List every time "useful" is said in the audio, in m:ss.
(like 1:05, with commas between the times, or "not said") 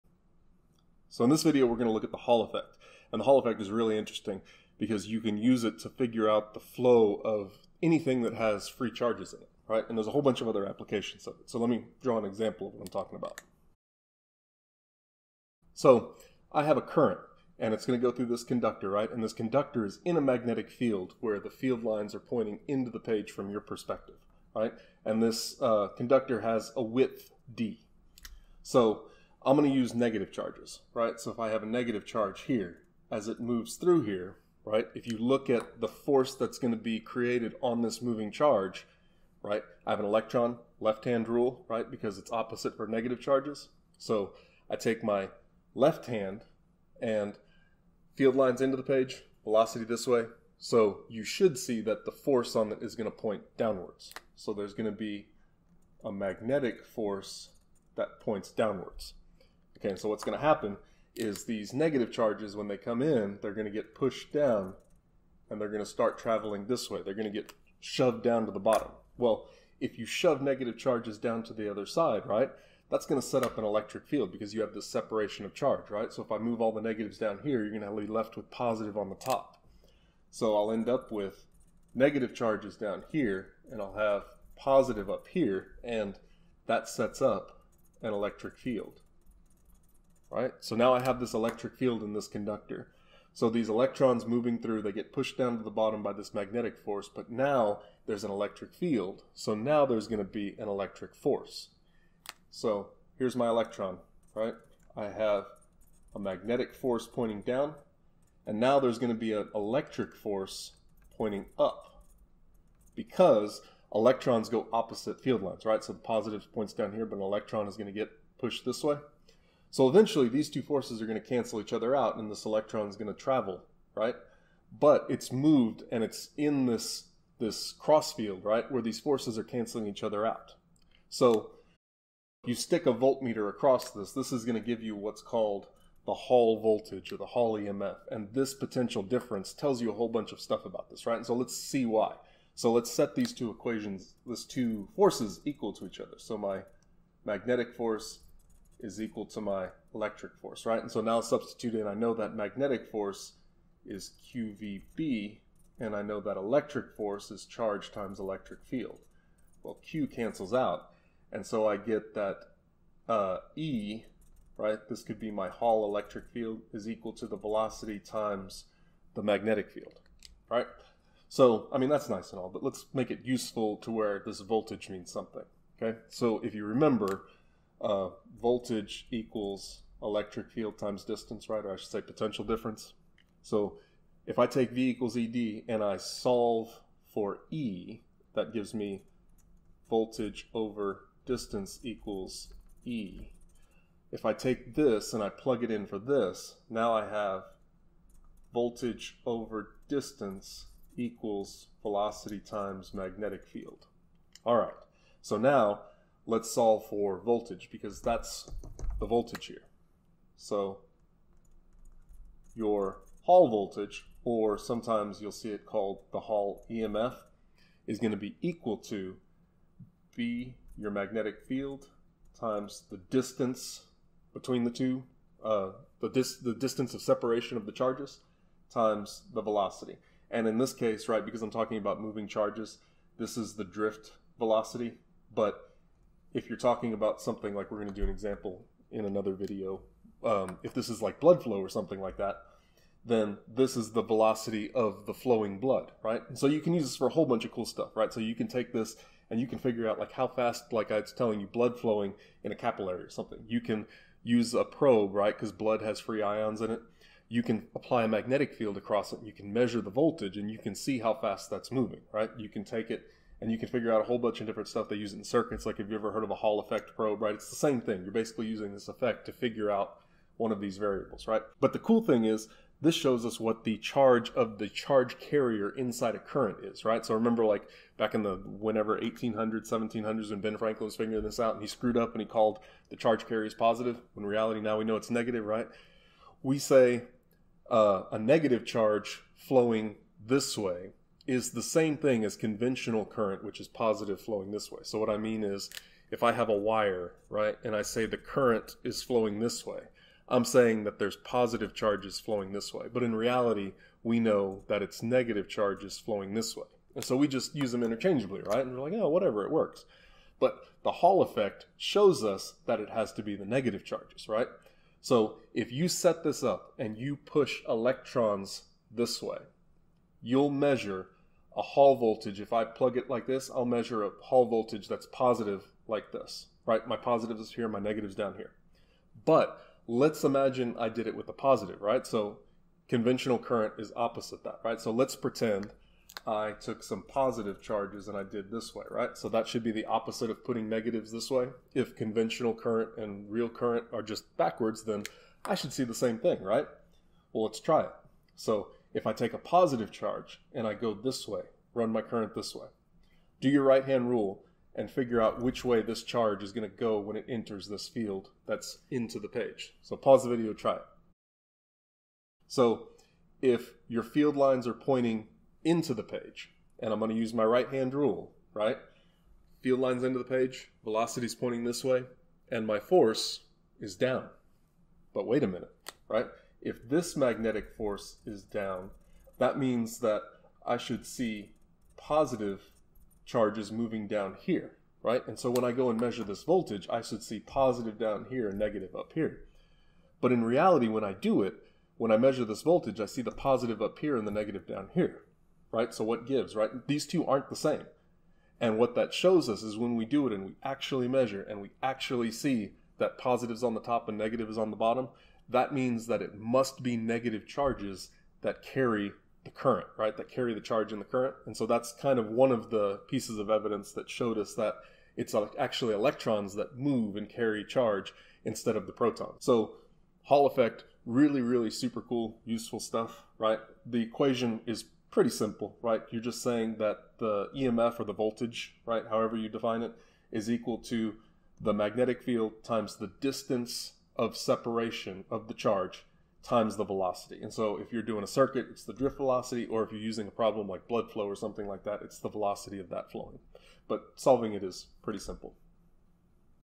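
2:53, 7:02.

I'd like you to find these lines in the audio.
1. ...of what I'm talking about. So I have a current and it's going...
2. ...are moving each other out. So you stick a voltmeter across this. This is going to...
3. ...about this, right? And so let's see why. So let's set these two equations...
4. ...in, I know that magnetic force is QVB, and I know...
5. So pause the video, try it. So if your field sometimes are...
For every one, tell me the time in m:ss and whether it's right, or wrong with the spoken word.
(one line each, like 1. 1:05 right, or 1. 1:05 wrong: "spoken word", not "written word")
1. 0:12 right
2. 2:09 wrong: "canceling", not "moving"
3. 2:20 right
4. 2:31 right
5. 5:59 wrong: "lines", not "sometimes".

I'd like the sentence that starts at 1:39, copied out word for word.
So now there's going to be an electric force.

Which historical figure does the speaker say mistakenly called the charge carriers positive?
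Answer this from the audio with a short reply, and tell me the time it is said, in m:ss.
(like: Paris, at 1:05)
Ben Franklin, at 4:40.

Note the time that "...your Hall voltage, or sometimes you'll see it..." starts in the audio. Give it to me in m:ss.
3:32.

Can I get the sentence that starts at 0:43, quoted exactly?
So I take my left hand and field lines into the page, velocity this way.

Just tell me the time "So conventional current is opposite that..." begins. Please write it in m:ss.
5:32.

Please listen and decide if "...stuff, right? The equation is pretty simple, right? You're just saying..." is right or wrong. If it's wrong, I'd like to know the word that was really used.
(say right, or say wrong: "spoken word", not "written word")
right.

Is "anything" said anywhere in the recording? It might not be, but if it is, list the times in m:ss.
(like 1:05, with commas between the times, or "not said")
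0:07.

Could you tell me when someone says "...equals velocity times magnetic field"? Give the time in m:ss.
3:20.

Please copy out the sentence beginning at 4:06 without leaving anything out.
And so you can use this for a whole bunch of cool stuff, right?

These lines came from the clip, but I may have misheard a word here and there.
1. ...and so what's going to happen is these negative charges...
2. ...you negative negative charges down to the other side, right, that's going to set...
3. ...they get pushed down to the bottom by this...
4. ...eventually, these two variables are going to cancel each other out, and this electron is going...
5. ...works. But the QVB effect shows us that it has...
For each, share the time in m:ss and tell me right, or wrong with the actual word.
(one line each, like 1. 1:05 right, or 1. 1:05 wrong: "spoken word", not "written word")
1. 0:59 right
2. 1:09 wrong: "shove", not "negative"
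3. 1:34 right
4. 1:59 wrong: "forces", not "variables"
5. 5:09 wrong: "Hall", not "QVB".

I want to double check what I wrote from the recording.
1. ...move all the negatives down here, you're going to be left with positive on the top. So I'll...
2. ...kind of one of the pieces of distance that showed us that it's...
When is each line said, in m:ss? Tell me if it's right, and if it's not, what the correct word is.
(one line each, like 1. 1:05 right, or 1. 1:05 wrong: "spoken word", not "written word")
1. 1:16 right
2. 6:51 wrong: "evidence", not "distance".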